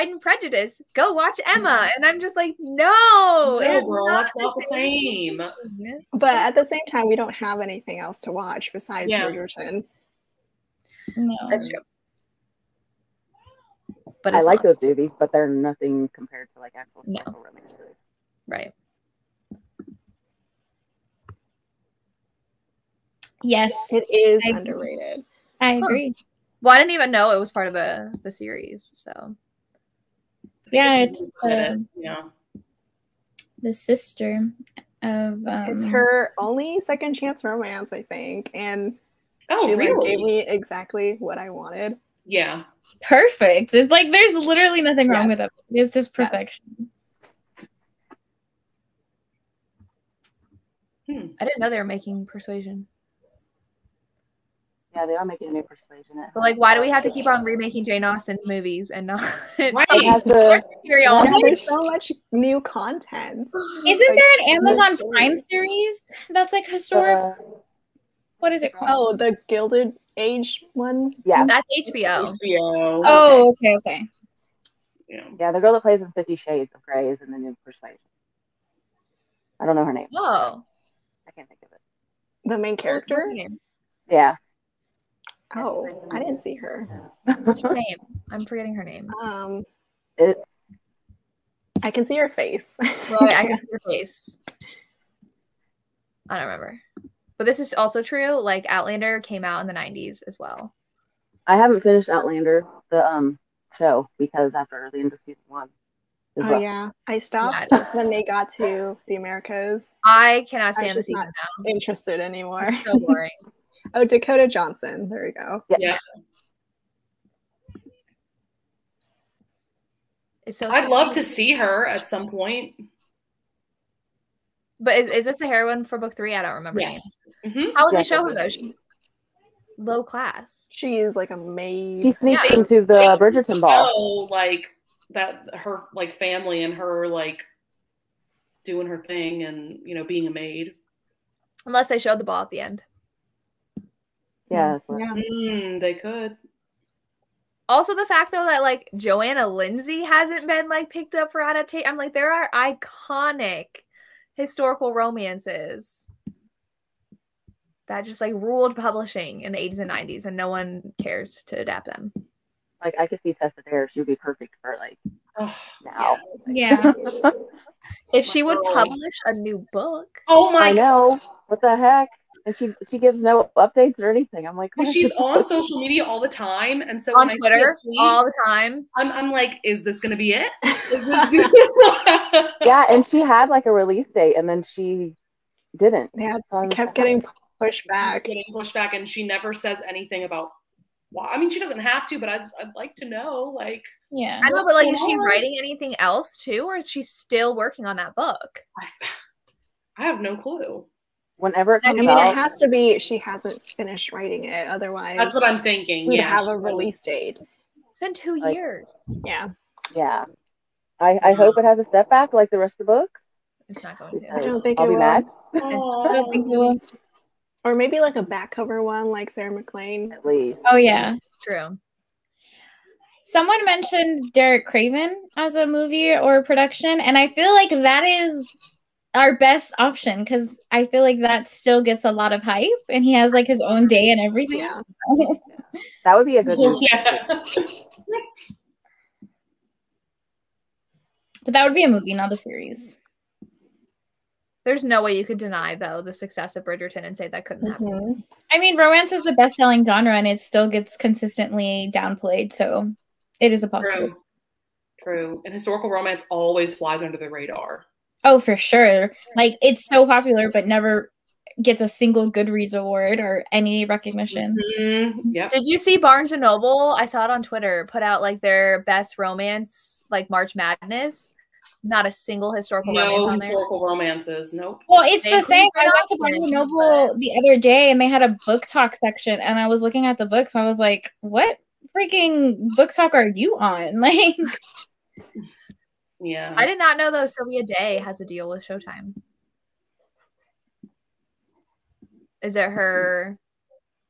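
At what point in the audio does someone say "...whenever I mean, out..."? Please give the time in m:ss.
3:21.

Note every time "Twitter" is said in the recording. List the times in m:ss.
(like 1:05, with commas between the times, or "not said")
2:57, 4:27.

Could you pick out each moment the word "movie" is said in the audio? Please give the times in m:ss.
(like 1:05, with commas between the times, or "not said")
0:14, 0:58, 3:45, 3:56, 4:01.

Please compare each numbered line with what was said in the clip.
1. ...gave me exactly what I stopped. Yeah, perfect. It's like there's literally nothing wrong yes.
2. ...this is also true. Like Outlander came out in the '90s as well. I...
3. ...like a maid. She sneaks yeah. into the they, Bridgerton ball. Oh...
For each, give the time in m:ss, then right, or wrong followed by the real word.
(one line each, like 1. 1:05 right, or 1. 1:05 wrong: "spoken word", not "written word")
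1. 0:40 wrong: "wanted", not "stopped"
2. 1:37 right
3. 2:11 right.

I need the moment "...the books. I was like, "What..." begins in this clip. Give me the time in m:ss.
4:40.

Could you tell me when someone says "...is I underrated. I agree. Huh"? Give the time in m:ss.
0:24.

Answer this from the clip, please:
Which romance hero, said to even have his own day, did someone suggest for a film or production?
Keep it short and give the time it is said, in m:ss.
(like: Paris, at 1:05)
Derek Craven, at 3:44.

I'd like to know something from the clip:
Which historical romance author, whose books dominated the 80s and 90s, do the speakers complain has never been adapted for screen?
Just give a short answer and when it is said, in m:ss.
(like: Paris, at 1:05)
Johanna Lindsey, at 2:28.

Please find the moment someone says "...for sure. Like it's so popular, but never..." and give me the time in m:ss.
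4:18.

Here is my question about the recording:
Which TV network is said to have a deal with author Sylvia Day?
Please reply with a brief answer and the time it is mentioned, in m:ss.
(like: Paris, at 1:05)
Showtime, at 4:48.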